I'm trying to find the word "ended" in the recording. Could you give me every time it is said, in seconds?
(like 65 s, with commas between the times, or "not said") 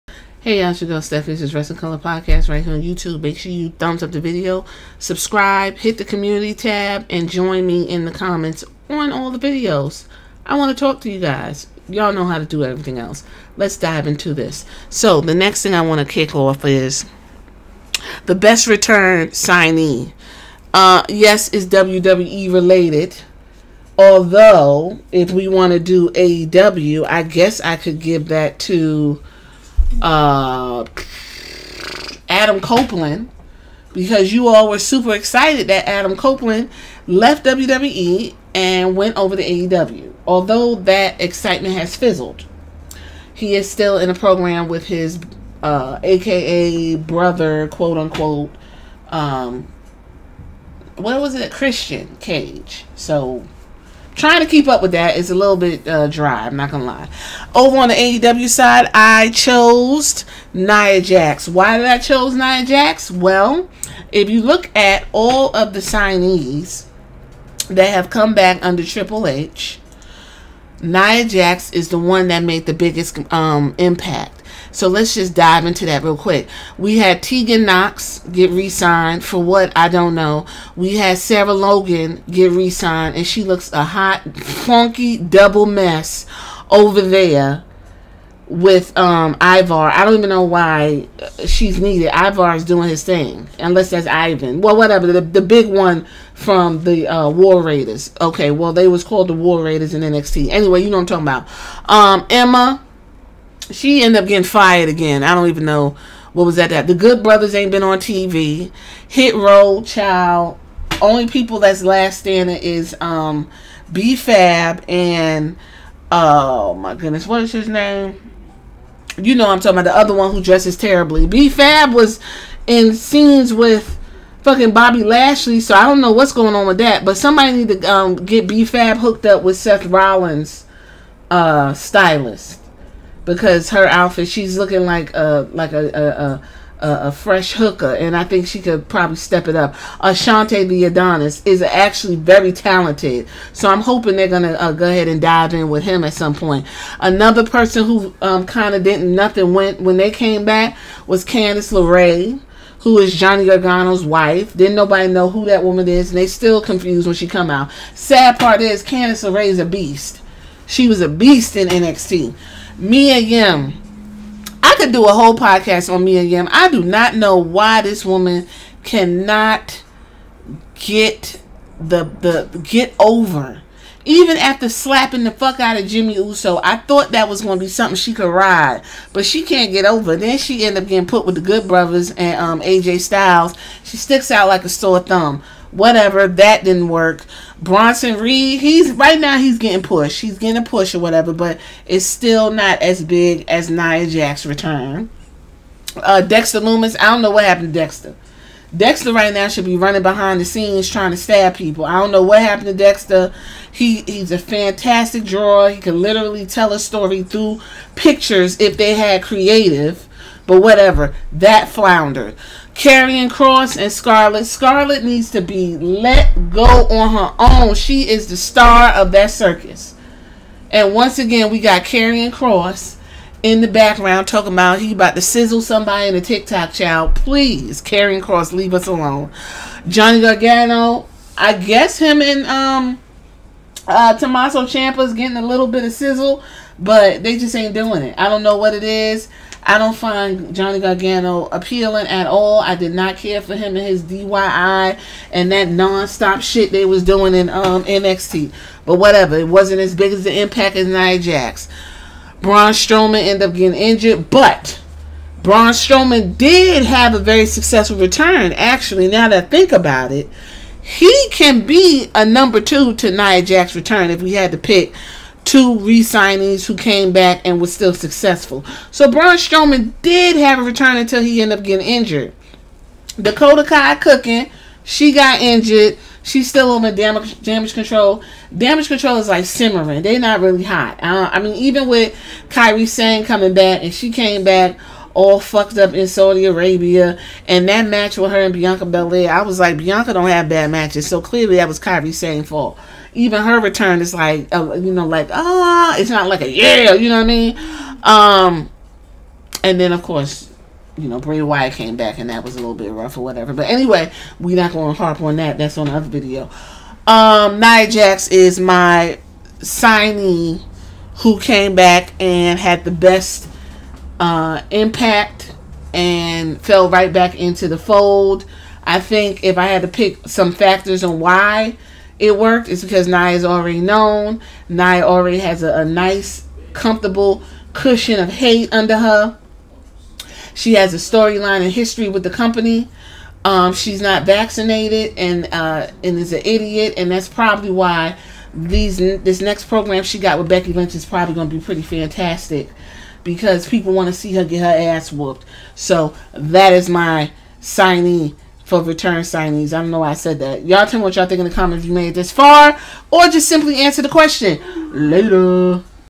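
104 s, 253 s, 271 s.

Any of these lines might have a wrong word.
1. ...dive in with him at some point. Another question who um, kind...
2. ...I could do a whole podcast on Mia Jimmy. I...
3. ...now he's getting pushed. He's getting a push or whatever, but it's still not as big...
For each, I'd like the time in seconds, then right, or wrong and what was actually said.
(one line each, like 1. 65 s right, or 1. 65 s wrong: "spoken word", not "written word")
1. 145 s wrong: "person", not "question"
2. 164 s wrong: "Yim", not "Jimmy"
3. 189 s right.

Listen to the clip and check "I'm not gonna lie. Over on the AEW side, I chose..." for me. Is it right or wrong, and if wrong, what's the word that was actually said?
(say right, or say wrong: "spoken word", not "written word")
right.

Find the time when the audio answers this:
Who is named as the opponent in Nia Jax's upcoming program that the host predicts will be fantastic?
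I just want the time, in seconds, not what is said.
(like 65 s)
340 s.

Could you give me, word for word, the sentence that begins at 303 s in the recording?
But anyway, we're not going to harp on that.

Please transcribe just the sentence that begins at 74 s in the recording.
So let's just dive into that real quick.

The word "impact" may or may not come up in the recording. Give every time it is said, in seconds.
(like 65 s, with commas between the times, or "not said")
73 s, 250 s, 314 s.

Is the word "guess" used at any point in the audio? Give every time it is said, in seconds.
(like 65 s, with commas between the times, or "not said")
27 s, 231 s.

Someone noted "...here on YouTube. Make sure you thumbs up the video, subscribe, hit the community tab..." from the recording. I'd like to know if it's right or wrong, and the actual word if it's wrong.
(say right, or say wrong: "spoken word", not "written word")
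right.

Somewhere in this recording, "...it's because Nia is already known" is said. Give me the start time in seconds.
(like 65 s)
322 s.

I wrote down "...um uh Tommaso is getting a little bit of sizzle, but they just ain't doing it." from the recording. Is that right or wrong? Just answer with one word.
right.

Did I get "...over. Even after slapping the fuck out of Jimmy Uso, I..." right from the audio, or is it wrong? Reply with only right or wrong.
right.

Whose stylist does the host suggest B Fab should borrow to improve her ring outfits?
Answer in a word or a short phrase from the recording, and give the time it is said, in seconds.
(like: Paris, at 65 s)
Seth Rollins, at 129 s.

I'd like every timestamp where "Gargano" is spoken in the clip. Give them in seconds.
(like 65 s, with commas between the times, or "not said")
153 s, 230 s, 240 s.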